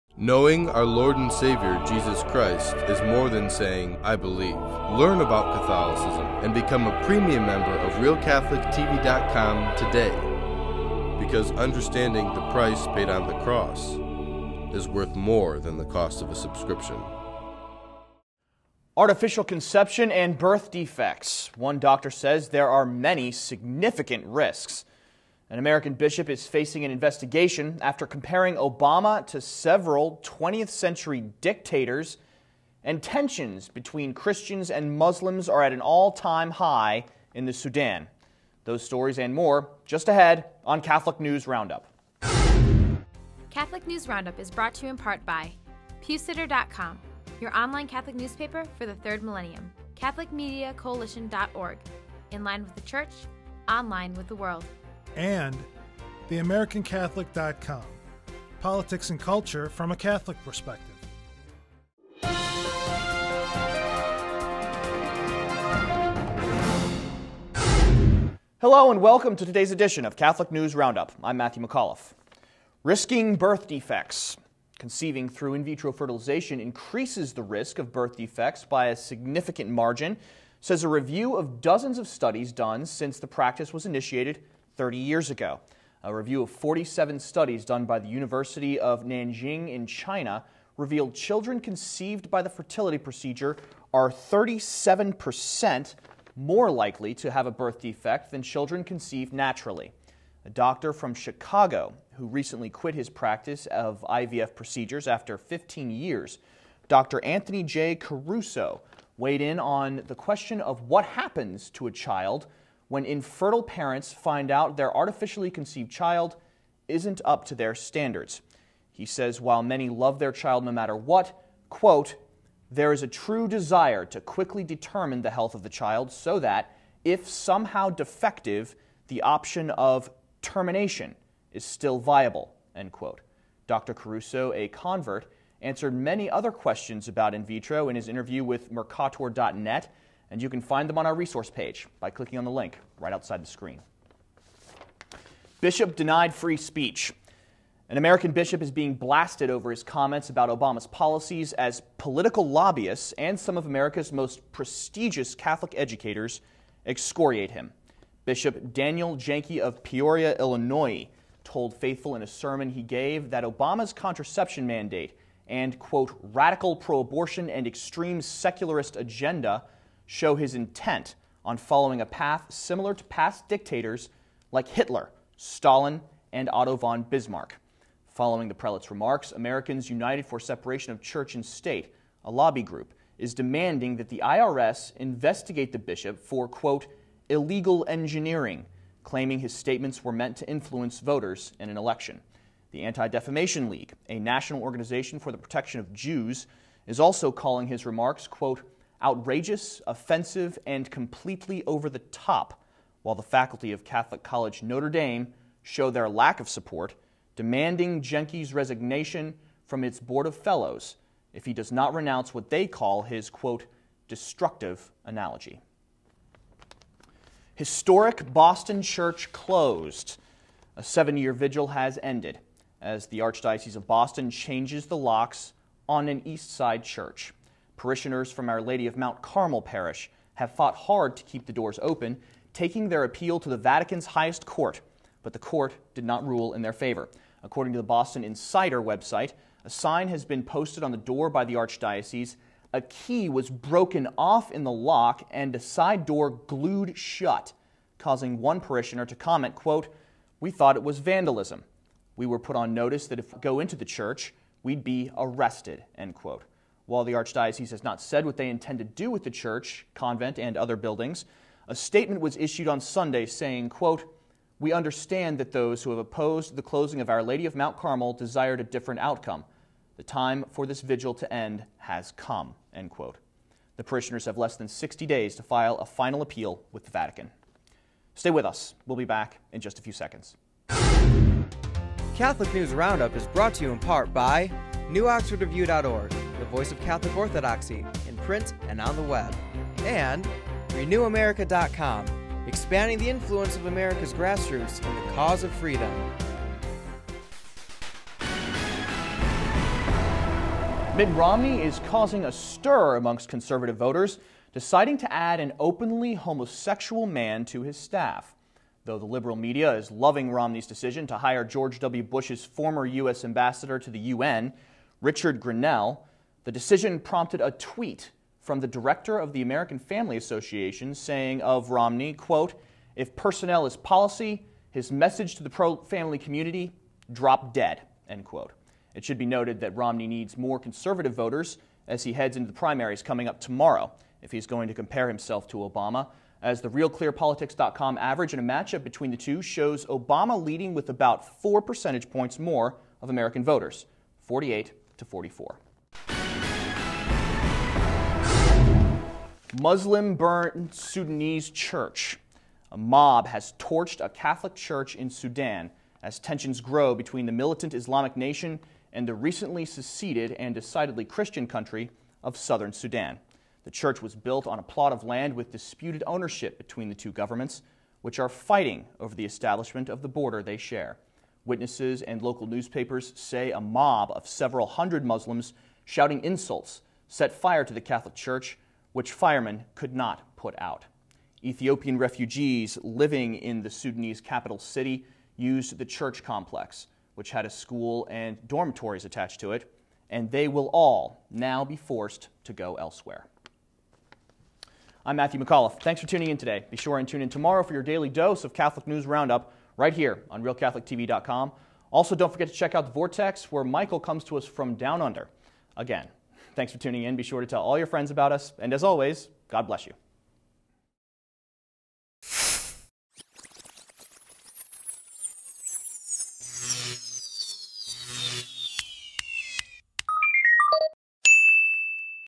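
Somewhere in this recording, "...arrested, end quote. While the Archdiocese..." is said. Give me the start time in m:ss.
4:15.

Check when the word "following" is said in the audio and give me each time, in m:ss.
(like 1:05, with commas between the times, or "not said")
2:51, 2:58.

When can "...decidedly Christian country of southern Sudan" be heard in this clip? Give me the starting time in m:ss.
6:00.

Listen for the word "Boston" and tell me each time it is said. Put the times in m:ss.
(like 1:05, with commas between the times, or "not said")
3:38, 3:43, 3:57.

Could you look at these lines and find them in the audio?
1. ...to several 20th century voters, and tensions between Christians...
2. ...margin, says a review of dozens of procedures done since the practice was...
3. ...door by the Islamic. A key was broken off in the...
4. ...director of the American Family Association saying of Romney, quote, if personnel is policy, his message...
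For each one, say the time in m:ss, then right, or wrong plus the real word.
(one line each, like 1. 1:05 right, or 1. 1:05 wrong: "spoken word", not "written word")
1. 0:29 wrong: "dictators", not "voters"
2. 1:19 wrong: "studies", not "procedures"
3. 4:01 wrong: "Archdiocese", not "Islamic"
4. 5:18 right.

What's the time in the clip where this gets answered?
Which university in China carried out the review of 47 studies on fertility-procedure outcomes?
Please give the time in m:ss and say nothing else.
1:28.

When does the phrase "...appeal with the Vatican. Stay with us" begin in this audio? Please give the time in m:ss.
4:36.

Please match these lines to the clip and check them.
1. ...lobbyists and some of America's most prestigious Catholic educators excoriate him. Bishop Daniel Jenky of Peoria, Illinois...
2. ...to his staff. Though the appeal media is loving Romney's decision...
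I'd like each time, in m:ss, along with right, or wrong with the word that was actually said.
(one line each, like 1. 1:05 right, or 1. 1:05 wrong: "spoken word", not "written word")
1. 2:32 right
2. 5:07 wrong: "liberal", not "appeal".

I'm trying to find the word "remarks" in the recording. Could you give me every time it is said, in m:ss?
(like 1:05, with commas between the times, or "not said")
2:58, 3:17.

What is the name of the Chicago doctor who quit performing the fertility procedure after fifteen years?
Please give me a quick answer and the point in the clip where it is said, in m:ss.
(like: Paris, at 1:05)
Anthony J. Caruso, at 1:47.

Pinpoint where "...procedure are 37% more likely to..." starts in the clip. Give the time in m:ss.
1:32.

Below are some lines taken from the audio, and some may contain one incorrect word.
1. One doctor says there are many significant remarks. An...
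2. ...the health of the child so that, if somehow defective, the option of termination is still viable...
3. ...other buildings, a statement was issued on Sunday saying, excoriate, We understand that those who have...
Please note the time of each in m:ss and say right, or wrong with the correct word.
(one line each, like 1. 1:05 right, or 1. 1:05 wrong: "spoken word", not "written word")
1. 0:21 wrong: "risks", not "remarks"
2. 2:05 right
3. 4:20 wrong: "quote", not "excoriate".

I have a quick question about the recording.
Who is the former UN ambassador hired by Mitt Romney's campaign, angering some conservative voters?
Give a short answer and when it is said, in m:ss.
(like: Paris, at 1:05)
Richard Grenell, at 5:15.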